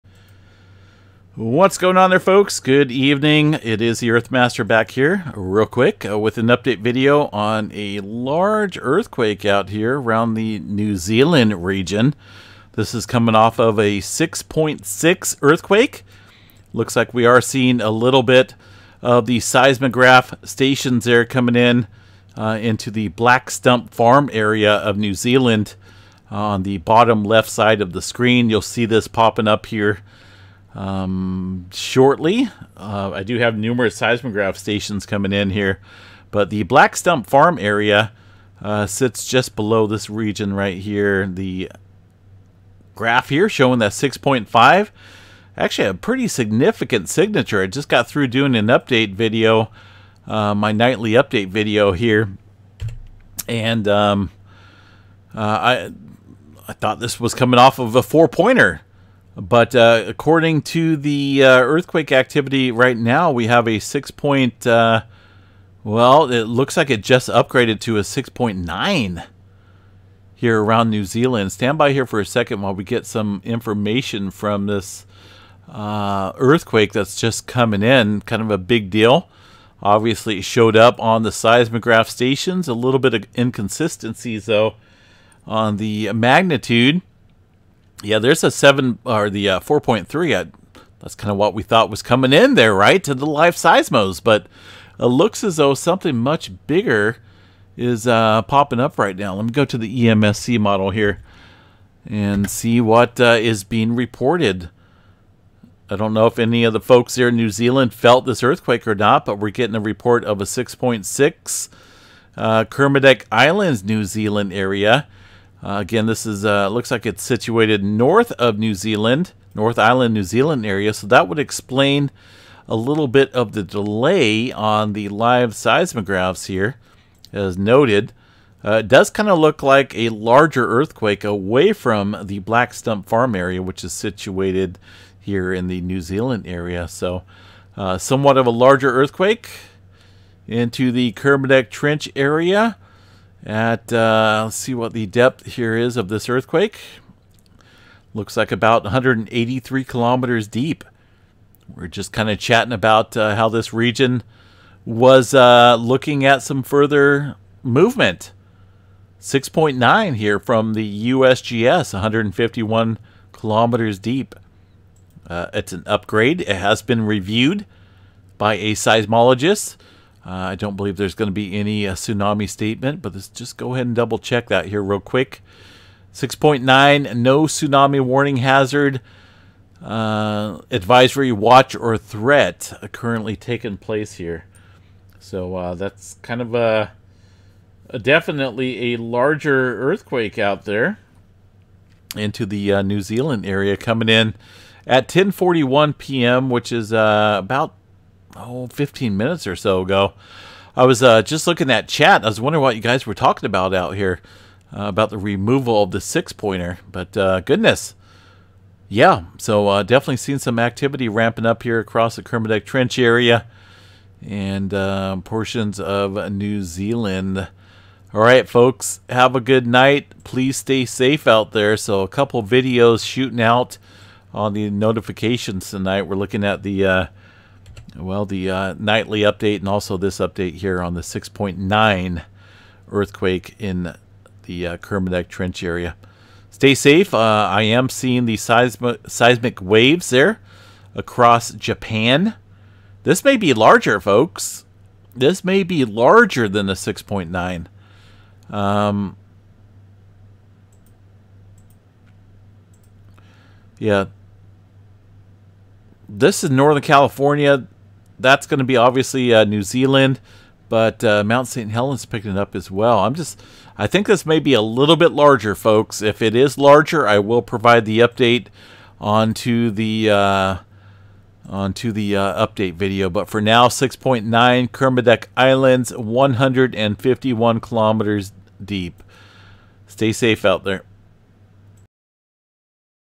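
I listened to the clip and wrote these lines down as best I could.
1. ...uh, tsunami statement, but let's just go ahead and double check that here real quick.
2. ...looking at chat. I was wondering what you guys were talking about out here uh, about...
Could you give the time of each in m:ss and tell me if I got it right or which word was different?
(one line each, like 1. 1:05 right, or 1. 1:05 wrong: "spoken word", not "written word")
1. 2:51 right
2. 3:21 right.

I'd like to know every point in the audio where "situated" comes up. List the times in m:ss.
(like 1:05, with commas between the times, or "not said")
1:57, 2:13.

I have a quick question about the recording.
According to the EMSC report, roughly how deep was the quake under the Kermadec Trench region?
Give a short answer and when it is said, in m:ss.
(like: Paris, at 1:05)
183 kilometers, at 2:28.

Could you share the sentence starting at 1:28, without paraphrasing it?
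Yeah, there's a 7 or the uh, 4.3.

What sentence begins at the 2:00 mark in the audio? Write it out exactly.
So that would explain a little bit of the delay on the live seismographs here, as noted.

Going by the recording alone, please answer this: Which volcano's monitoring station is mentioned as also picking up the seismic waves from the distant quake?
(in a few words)
Mount St. Helens.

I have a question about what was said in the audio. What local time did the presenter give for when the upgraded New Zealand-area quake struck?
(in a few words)
10:41 p.m.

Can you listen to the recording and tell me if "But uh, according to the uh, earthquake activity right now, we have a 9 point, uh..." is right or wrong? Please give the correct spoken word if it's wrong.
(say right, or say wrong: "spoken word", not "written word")
wrong: "6", not "9".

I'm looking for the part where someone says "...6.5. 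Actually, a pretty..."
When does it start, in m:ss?
0:43.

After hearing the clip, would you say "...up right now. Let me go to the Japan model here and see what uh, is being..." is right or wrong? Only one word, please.
wrong.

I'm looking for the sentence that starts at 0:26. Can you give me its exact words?
Uh, on the bottom left side of the screen, you'll see this popping up here um, shortly.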